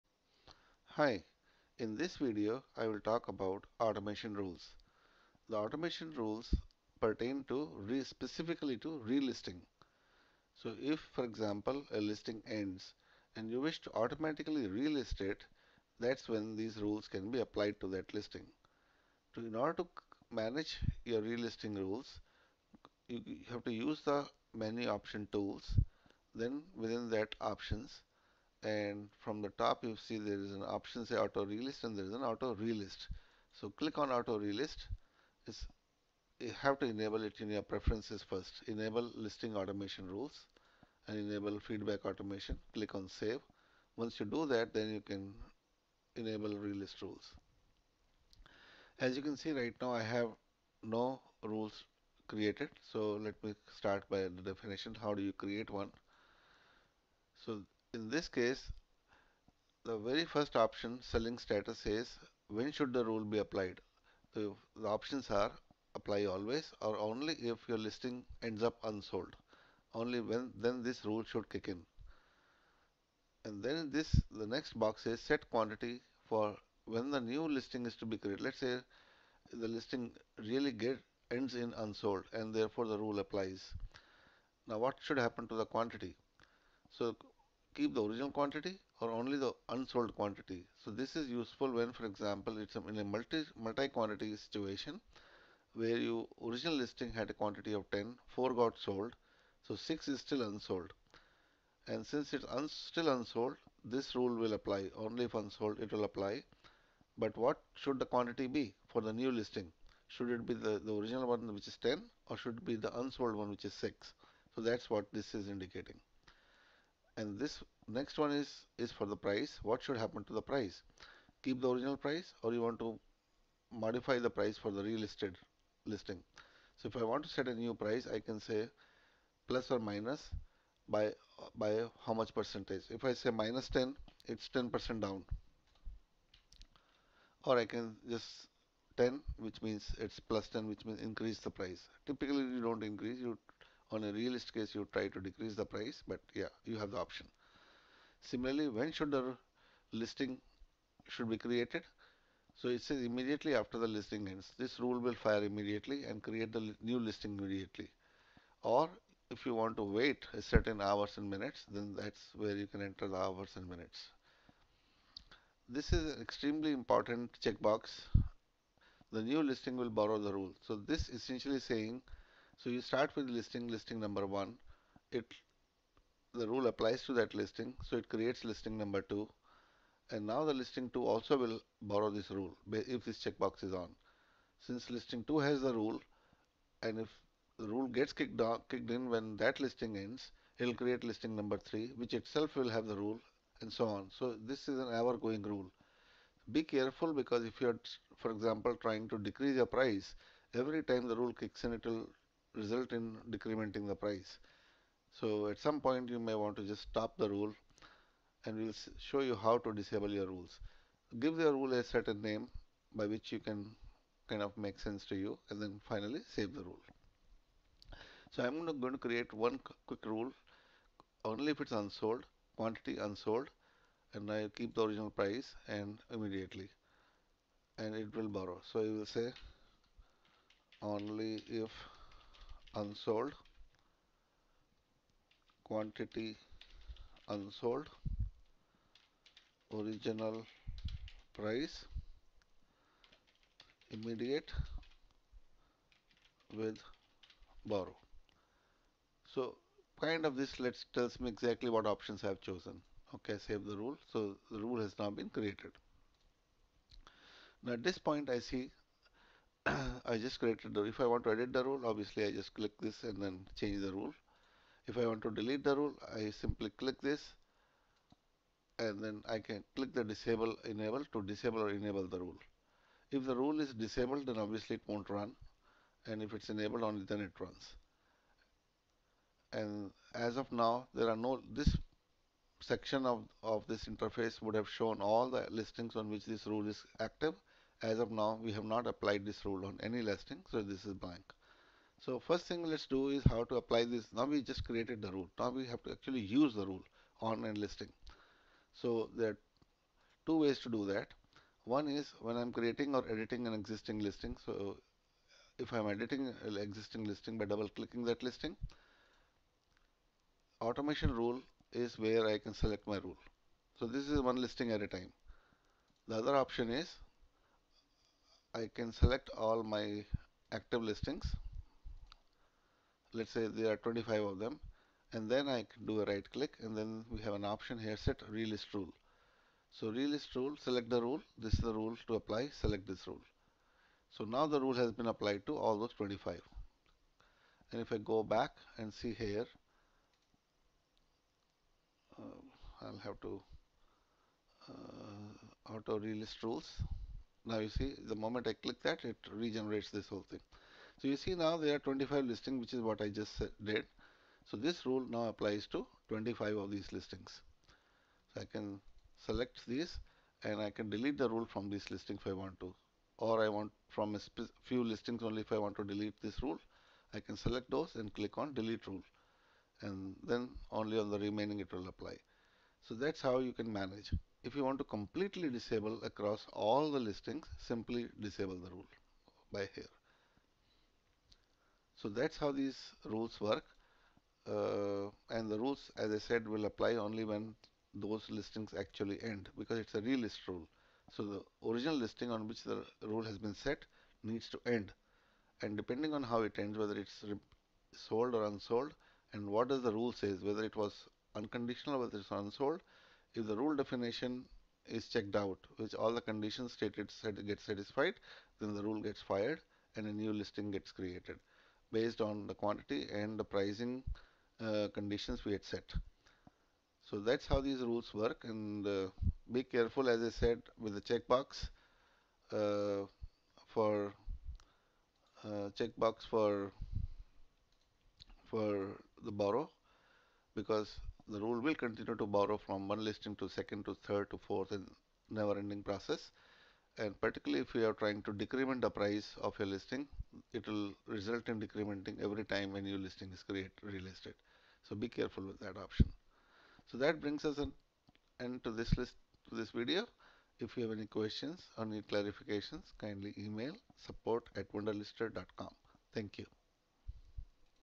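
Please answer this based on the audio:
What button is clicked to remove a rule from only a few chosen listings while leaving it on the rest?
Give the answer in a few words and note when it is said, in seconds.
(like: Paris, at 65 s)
delete rule, at 368 s.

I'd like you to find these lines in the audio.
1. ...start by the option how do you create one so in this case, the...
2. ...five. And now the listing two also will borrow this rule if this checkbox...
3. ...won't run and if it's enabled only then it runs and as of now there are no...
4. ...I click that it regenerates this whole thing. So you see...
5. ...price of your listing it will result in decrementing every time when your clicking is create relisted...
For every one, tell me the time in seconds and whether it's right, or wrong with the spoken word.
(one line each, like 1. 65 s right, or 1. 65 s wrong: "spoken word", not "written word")
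1. 53 s wrong: "definition", not "option"
2. 179 s wrong: "two", not "five"
3. 274 s right
4. 348 s right
5. 438 s wrong: "listing", not "clicking".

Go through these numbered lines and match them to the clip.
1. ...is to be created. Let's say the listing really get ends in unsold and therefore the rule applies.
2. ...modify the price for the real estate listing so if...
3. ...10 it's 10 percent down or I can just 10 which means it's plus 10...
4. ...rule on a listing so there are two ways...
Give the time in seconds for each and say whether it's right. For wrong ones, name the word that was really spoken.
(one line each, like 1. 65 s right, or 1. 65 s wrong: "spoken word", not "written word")
1. 77 s right
2. 123 s right
3. 133 s right
4. 296 s right.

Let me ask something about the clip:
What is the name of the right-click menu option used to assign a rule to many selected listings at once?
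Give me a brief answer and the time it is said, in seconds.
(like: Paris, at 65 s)
set relist rule, at 327 s.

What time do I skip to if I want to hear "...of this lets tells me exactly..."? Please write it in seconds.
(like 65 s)
250 s.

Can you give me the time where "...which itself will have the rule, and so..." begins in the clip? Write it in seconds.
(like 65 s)
191 s.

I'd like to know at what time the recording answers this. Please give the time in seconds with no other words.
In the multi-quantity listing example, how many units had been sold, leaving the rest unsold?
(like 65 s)
98 s.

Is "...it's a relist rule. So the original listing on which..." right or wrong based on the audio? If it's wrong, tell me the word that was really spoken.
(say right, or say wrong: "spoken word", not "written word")
right.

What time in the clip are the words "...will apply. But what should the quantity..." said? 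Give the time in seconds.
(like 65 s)
105 s.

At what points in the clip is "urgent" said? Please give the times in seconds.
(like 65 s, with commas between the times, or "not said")
not said.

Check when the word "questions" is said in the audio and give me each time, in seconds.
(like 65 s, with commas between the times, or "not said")
451 s.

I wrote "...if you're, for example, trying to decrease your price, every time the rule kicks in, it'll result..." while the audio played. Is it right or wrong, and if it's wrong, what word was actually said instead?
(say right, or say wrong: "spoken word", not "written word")
right.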